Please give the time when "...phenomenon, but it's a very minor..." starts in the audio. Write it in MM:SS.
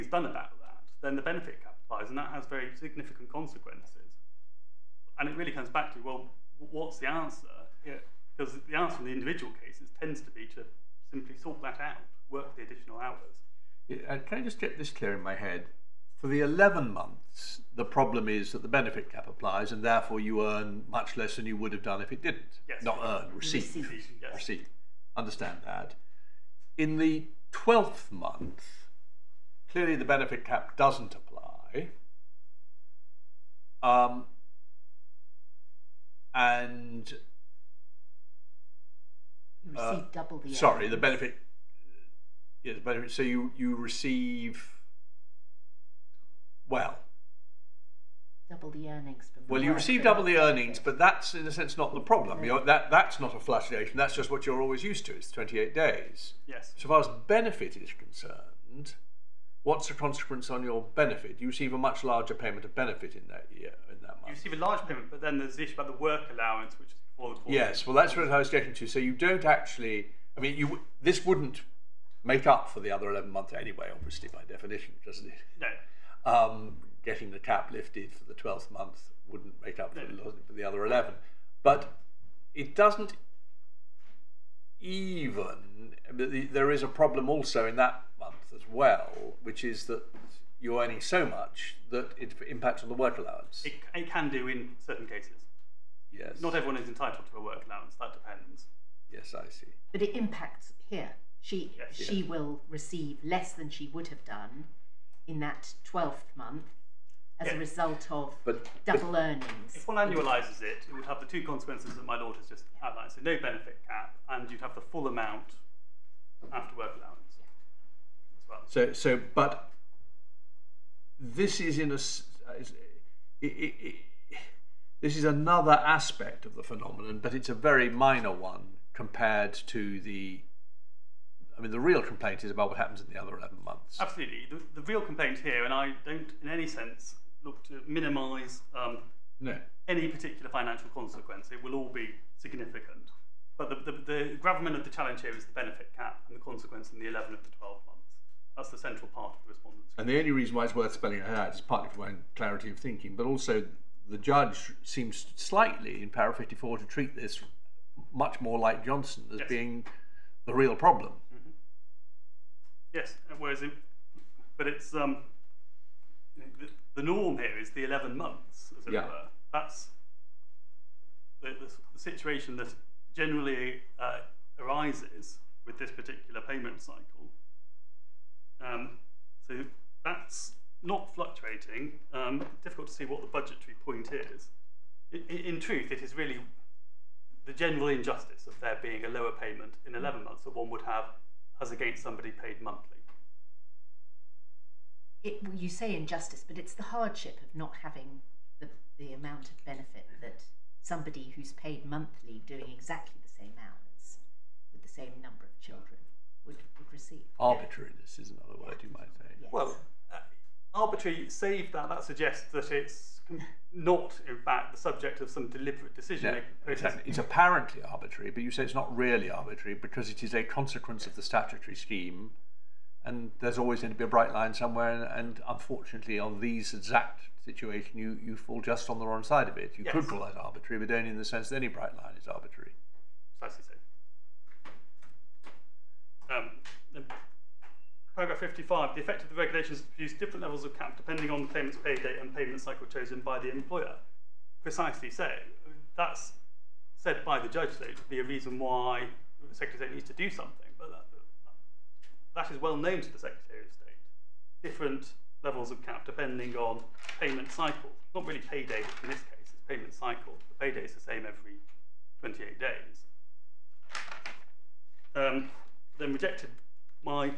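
02:06.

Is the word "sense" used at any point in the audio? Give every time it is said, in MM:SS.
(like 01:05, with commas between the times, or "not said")
00:51, 02:16, 03:51.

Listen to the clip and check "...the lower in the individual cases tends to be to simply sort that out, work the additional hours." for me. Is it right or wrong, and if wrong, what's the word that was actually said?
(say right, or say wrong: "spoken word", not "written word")
wrong: "answer", not "lower".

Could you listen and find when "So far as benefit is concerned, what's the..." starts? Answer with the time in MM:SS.
00:56.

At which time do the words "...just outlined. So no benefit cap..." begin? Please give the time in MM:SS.
01:52.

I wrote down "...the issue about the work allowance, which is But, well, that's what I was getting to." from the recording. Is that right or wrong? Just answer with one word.
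wrong.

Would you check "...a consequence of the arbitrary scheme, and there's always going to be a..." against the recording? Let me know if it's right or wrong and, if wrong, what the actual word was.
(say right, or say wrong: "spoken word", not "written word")
wrong: "statutory", not "arbitrary".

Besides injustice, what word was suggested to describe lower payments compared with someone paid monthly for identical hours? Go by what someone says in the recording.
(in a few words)
Arbitrariness.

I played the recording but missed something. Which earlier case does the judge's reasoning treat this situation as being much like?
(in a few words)
Johnson.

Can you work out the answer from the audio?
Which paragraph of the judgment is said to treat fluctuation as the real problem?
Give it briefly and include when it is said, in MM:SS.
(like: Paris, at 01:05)
54, at 02:36.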